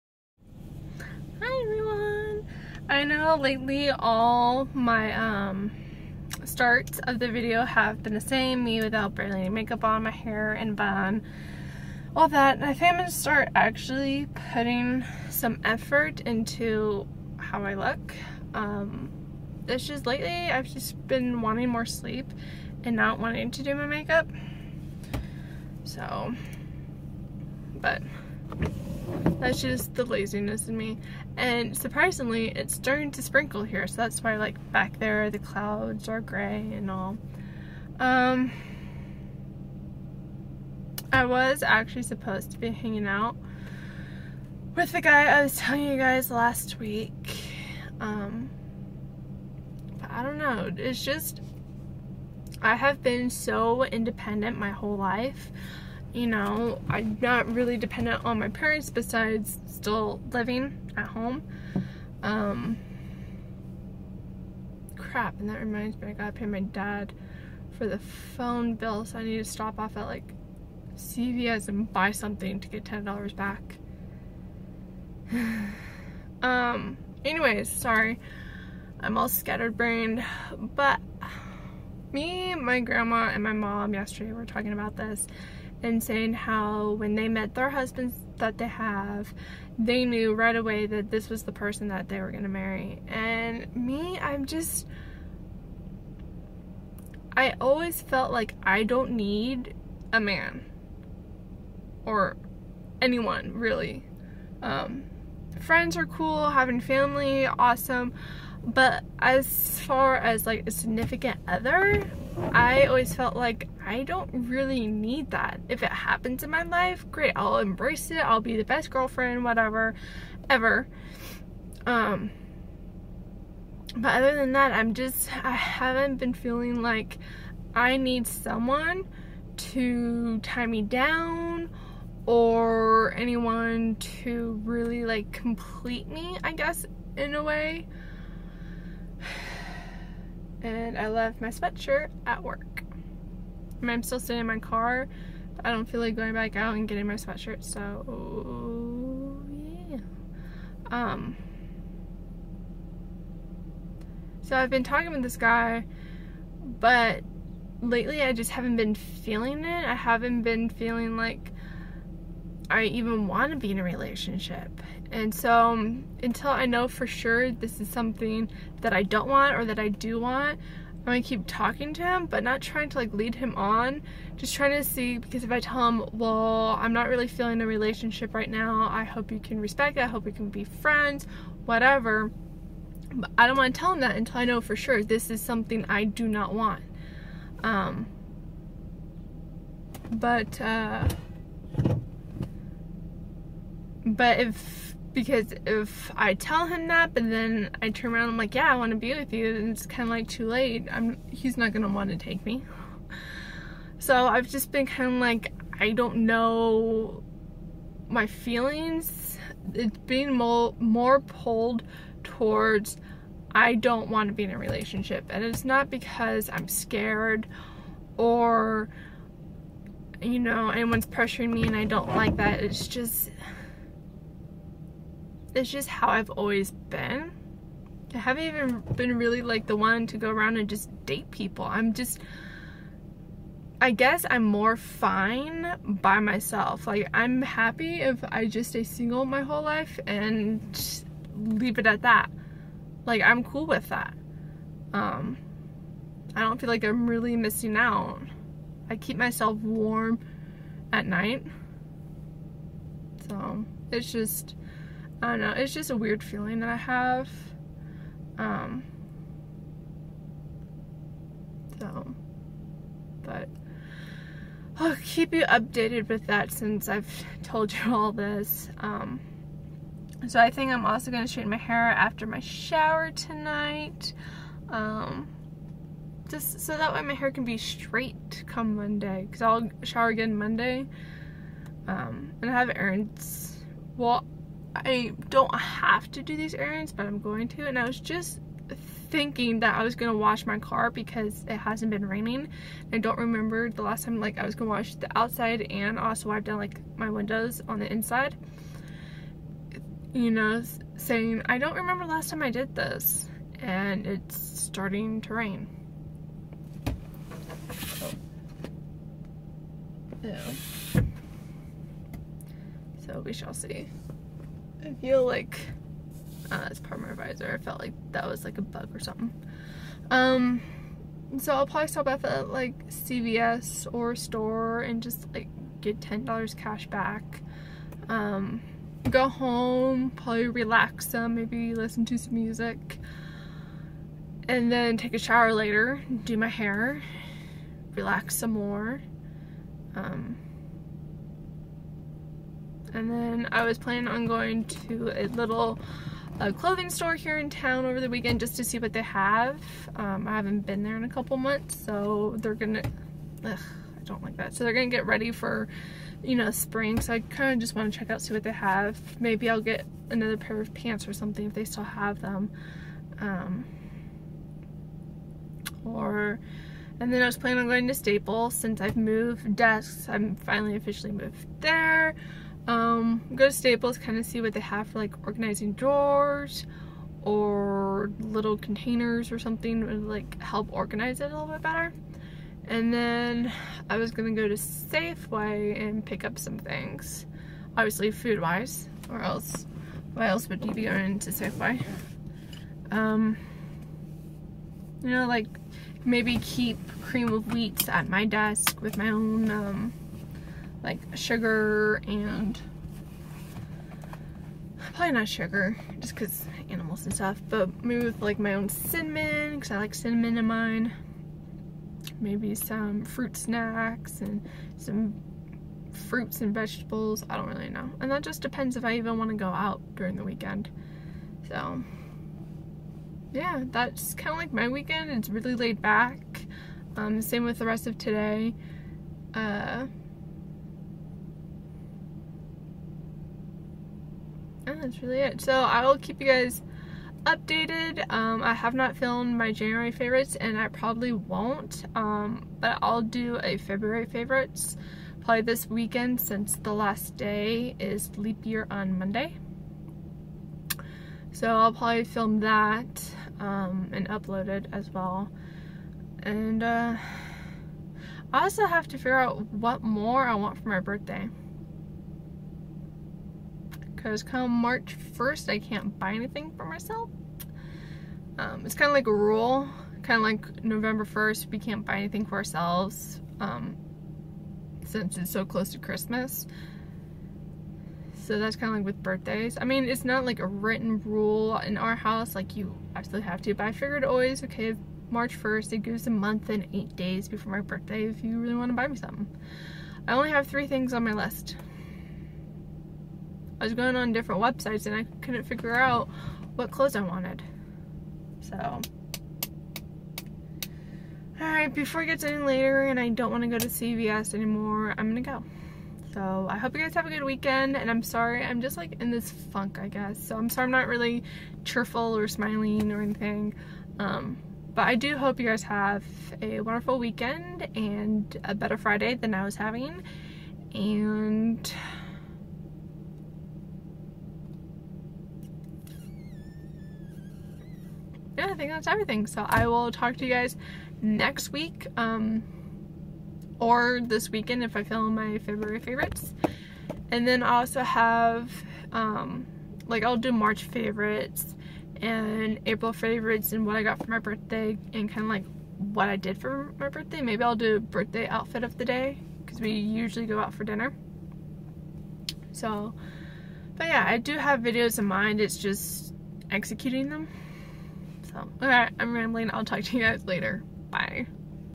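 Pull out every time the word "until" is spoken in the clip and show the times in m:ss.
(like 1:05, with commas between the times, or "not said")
2:46, 3:04.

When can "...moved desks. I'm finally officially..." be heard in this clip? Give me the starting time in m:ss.
6:08.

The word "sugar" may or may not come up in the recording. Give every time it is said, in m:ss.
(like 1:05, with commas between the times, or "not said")
6:41, 6:45.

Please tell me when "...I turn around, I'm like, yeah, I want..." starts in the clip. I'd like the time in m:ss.
3:17.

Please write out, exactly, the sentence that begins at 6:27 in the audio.
Obviously food wise, or else why else would you be going to Safeway?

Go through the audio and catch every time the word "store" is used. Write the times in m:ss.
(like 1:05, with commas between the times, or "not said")
5:24, 5:46.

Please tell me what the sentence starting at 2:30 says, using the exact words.
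Um, so I've been talking with this guy, but lately I just haven't been feeling it.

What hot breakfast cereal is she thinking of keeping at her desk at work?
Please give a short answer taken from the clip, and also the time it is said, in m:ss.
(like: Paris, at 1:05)
Cream of wheat, at 6:37.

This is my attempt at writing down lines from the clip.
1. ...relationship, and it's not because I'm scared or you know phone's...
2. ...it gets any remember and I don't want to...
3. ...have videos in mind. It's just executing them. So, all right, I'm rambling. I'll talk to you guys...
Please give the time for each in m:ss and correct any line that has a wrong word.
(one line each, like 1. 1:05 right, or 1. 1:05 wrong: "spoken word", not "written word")
1. 3:34 wrong: "anyone", not "phone"
2. 8:22 wrong: "later", not "remember"
3. 9:14 right.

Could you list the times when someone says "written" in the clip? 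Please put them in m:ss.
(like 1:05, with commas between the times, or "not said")
8:00.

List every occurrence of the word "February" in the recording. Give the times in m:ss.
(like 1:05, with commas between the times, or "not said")
7:23, 8:55.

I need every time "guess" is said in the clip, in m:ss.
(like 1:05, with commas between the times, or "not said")
2:16, 3:53, 8:29.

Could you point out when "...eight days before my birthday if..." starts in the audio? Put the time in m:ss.
8:06.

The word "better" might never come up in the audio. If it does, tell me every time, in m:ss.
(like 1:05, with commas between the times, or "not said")
6:21, 8:38.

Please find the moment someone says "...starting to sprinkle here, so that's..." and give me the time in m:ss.
0:32.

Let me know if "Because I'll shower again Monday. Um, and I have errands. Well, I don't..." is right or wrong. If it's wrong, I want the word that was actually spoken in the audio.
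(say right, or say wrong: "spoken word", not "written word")
right.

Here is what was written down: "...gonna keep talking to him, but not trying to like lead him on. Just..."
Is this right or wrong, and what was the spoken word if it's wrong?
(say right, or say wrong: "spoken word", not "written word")
right.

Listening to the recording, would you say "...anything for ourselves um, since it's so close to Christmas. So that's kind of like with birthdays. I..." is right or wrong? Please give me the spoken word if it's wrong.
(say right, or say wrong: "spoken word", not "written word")
right.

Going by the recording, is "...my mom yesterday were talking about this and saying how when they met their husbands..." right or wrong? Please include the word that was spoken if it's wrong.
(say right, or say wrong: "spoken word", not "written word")
right.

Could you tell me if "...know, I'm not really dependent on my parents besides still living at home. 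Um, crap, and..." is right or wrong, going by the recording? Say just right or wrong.
right.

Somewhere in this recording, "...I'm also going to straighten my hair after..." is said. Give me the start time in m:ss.
4:30.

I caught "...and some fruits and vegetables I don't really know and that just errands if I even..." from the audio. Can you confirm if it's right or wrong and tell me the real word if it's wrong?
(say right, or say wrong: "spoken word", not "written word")
wrong: "depends", not "errands".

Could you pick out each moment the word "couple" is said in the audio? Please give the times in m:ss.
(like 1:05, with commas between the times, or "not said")
5:51.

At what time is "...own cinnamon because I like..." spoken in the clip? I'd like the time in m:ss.
6:48.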